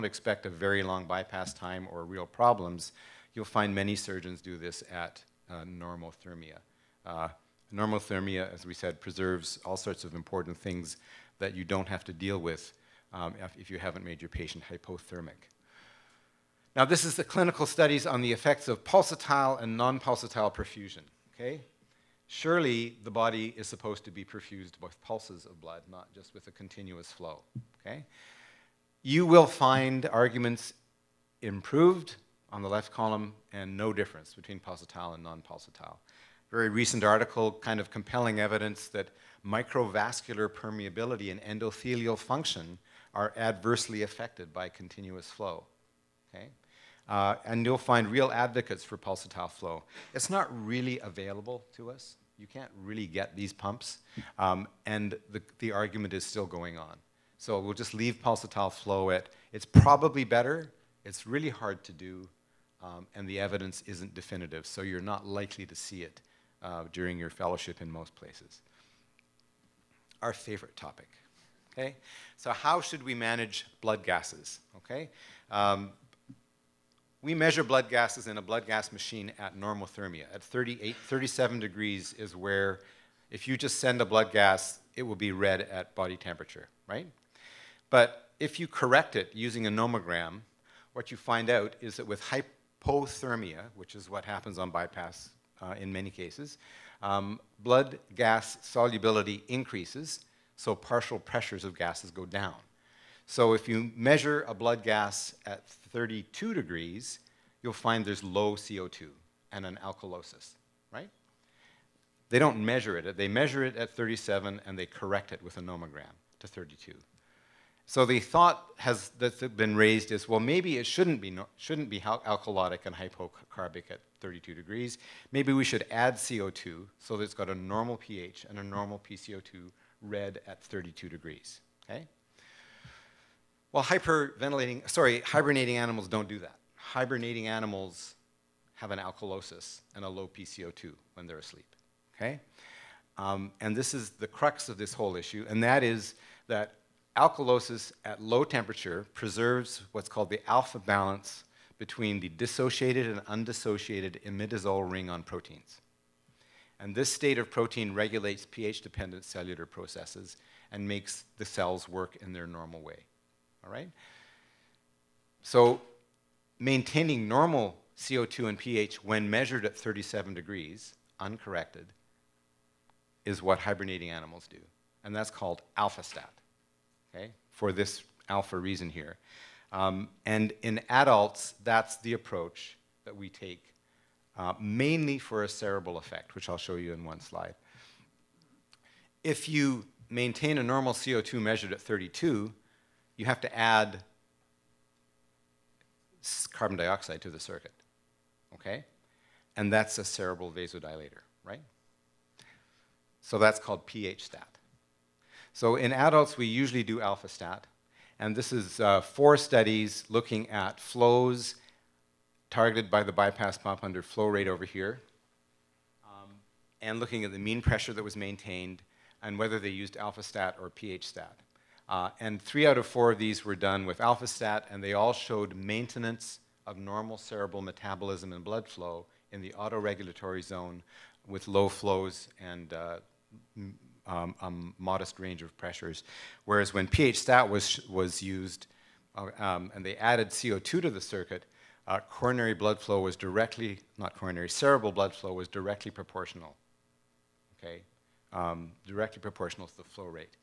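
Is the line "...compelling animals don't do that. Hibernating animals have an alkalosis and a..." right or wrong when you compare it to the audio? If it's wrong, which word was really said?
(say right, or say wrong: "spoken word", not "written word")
wrong: "hibernating", not "compelling".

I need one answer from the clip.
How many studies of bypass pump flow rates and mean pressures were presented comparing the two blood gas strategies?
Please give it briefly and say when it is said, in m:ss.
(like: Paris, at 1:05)
4, at 3:29.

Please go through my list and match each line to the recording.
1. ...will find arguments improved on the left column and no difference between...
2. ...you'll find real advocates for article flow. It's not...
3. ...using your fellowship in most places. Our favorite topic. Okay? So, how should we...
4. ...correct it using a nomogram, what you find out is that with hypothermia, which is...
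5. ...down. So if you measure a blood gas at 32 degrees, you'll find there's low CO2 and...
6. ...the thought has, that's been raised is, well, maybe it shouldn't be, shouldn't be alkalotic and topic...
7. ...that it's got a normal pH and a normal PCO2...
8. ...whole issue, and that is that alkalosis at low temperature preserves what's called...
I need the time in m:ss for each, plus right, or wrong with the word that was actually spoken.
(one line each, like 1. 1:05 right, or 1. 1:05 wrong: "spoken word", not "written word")
1. 0:29 right
2. 0:47 wrong: "pulsatile", not "article"
3. 1:06 wrong: "during", not "using"
4. 1:28 right
5. 1:42 right
6. 1:58 wrong: "hypocarbic", not "topic"
7. 2:07 right
8. 2:24 right.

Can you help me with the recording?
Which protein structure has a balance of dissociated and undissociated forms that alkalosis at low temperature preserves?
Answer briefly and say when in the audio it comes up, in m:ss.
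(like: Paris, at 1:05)
imidazole ring, at 2:34.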